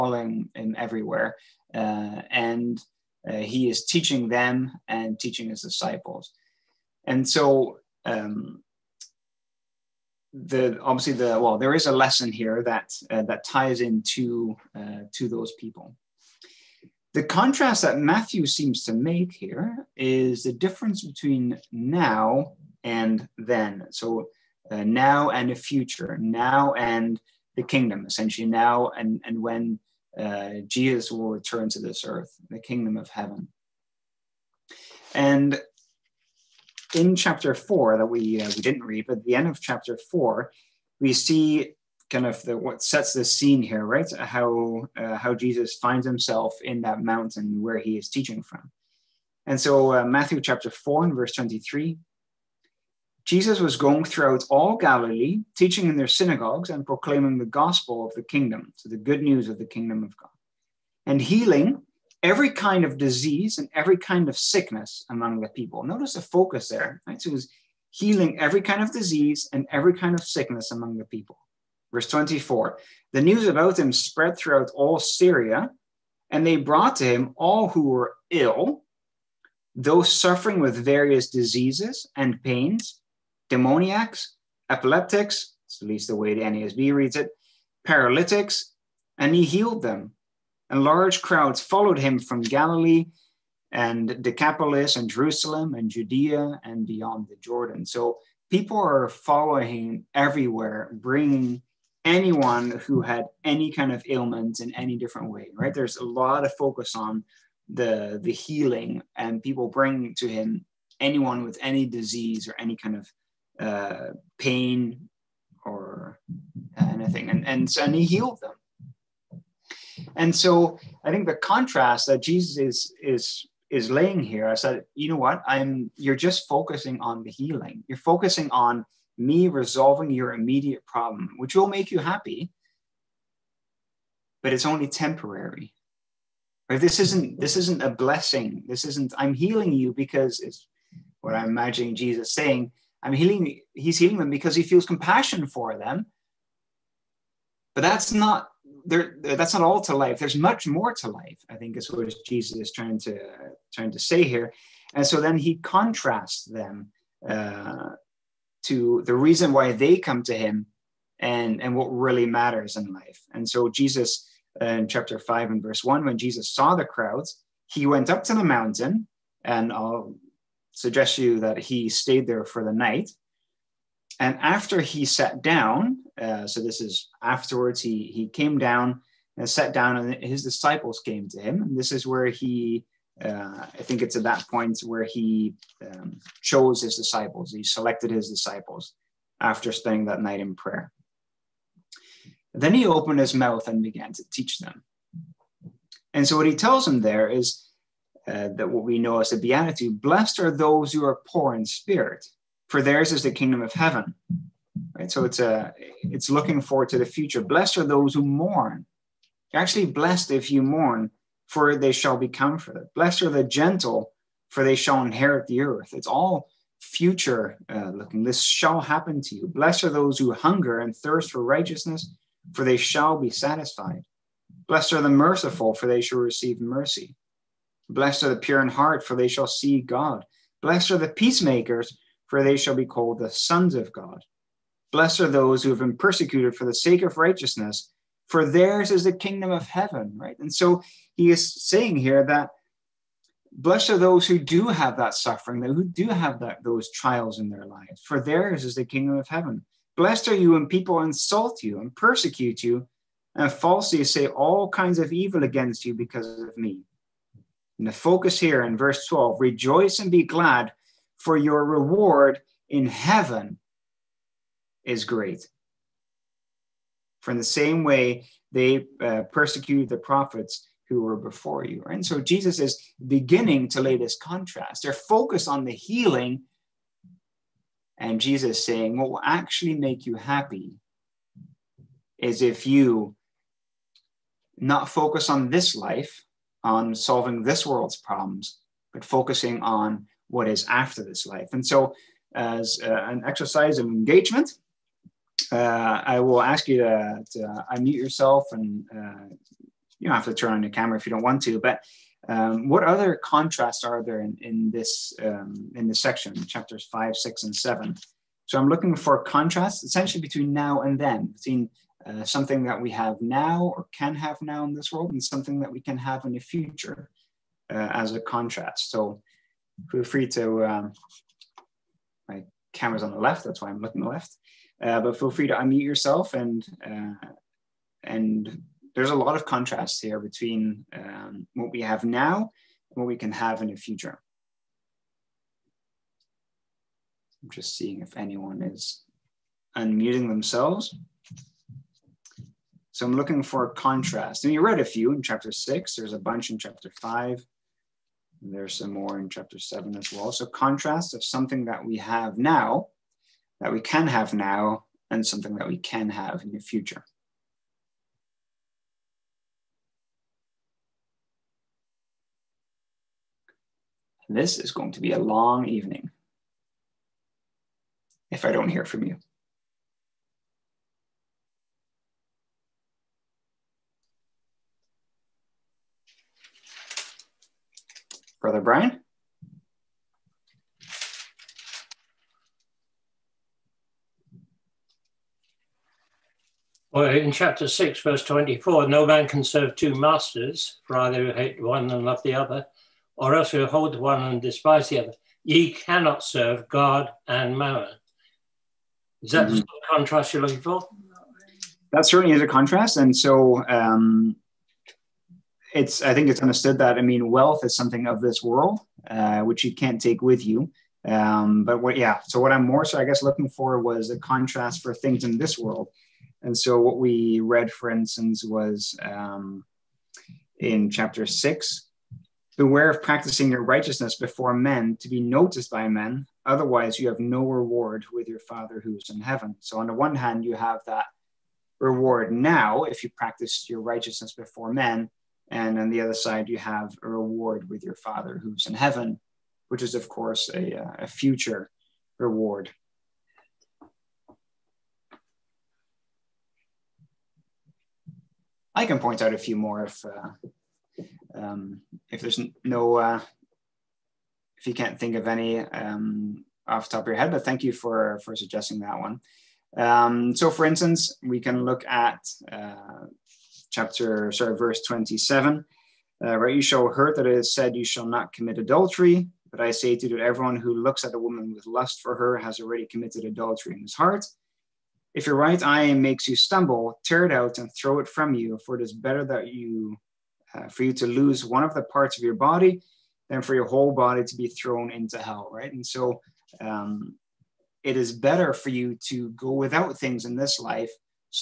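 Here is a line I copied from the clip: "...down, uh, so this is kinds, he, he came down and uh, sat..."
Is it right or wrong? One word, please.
wrong.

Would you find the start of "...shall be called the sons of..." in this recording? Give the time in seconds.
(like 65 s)
232 s.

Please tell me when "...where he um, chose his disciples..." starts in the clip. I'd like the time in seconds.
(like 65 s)
184 s.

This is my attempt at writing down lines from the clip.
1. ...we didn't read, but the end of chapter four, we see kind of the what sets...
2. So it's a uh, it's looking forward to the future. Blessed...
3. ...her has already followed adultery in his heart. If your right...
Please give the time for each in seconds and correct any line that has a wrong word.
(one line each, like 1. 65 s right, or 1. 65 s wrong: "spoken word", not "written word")
1. 38 s right
2. 205 s right
3. 472 s wrong: "committed", not "followed".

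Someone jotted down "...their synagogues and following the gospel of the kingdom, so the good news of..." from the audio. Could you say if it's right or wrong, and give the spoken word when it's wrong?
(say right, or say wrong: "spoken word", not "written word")
wrong: "proclaiming", not "following".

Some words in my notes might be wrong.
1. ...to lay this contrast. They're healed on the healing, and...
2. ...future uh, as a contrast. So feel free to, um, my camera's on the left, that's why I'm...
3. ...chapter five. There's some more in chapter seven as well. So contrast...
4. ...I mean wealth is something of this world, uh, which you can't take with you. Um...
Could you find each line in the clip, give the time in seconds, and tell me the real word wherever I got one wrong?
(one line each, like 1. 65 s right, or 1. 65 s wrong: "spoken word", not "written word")
1. 273 s wrong: "focused", not "healed"
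2. 316 s right
3. 346 s right
4. 406 s right.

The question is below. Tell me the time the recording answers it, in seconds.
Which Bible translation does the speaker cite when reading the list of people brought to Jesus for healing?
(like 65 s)
86 s.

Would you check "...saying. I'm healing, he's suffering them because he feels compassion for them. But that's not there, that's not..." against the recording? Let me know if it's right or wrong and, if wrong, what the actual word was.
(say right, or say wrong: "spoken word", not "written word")
wrong: "healing", not "suffering".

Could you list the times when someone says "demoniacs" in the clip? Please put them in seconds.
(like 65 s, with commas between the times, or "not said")
83 s.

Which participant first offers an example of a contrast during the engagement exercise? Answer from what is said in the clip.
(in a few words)
Brian.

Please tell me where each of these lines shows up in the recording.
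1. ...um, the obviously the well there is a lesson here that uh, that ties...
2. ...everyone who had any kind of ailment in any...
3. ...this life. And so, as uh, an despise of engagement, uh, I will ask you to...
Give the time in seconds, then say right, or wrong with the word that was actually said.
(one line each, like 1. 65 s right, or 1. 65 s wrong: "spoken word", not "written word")
1. 8 s right
2. 102 s wrong: "anyone", not "everyone"
3. 291 s wrong: "exercise", not "despise".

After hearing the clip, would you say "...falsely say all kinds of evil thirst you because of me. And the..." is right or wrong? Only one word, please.
wrong.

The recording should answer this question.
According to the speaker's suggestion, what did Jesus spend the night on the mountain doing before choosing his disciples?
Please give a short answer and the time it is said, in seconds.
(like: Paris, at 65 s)
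Prayer, at 190 s.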